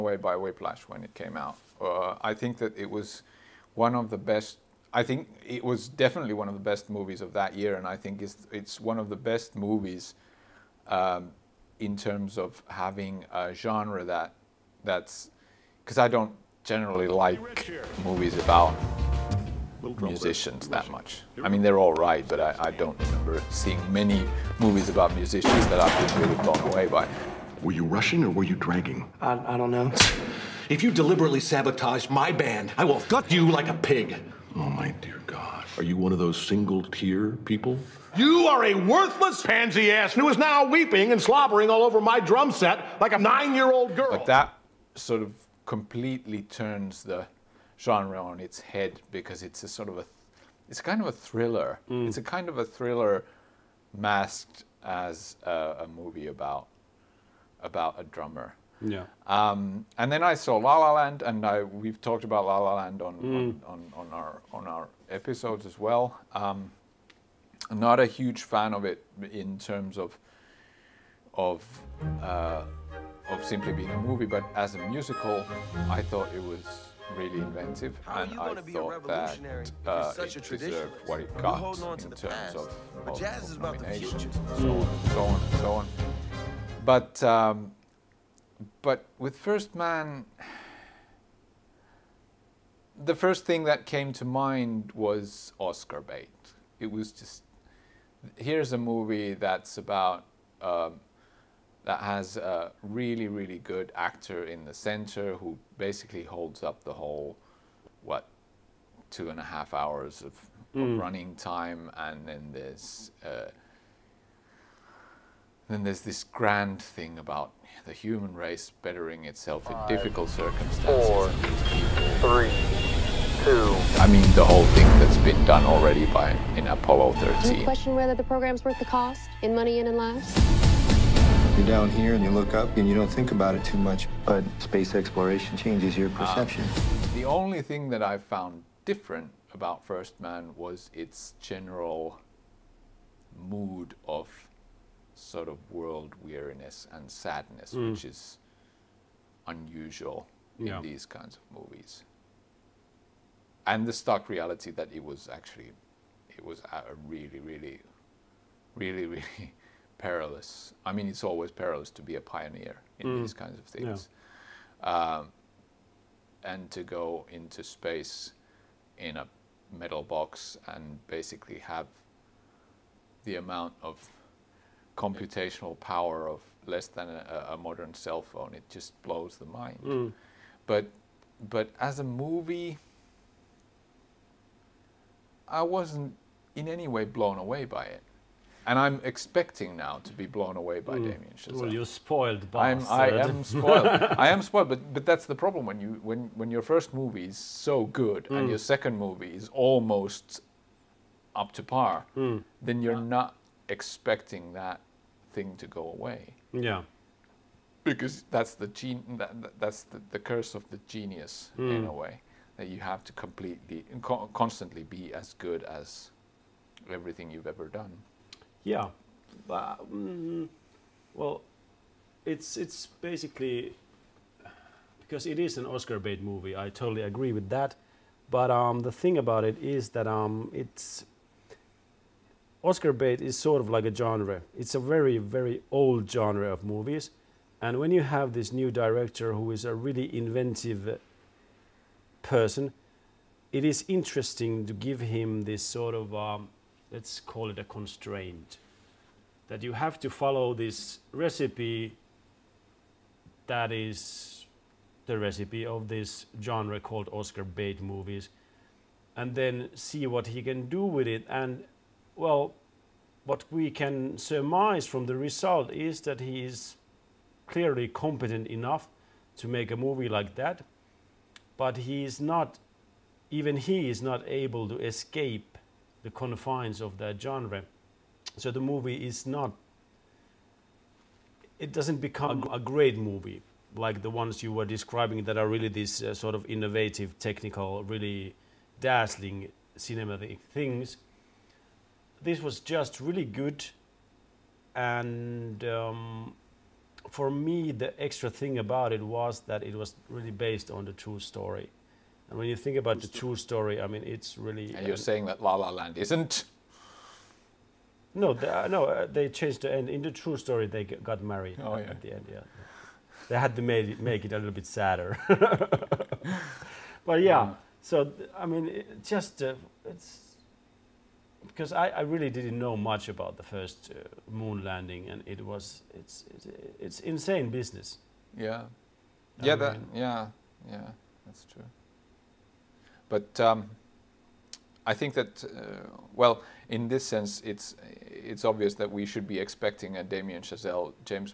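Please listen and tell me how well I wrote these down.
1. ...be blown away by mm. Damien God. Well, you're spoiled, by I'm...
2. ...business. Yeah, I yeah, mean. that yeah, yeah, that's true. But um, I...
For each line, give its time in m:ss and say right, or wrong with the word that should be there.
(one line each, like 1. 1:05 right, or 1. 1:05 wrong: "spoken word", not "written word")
1. 3:10 wrong: "Chazelle", not "God"
2. 5:27 right.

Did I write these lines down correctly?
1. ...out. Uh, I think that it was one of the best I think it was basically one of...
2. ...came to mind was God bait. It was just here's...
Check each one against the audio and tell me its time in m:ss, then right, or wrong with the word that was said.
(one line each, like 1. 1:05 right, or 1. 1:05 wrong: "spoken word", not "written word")
1. 0:01 wrong: "definitely", not "basically"
2. 1:33 wrong: "Oscar", not "God".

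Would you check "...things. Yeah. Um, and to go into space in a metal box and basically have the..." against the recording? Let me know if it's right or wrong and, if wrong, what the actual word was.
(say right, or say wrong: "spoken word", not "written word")
right.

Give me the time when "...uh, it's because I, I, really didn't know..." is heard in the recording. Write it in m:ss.
5:19.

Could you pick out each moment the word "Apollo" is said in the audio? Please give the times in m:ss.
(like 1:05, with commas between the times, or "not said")
2:06.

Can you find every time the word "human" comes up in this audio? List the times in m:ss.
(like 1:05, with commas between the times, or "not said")
1:57.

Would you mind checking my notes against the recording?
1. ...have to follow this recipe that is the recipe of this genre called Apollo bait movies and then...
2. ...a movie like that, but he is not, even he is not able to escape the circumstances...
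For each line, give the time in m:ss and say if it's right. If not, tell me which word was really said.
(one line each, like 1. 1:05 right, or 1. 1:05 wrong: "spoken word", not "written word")
1. 4:09 wrong: "Oscar", not "Apollo"
2. 4:29 wrong: "confines", not "circumstances".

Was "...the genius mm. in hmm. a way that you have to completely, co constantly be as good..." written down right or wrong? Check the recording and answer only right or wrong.
right.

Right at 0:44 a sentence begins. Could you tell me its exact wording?
But that sort of completely turns the genre on its head because it's a sort of a, it's kind of a thriller.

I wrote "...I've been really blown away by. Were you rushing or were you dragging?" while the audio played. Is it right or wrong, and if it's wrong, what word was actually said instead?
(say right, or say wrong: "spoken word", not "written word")
right.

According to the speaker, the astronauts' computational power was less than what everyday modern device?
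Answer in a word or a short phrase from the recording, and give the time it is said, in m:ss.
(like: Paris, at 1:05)
A modern cell phone, at 2:57.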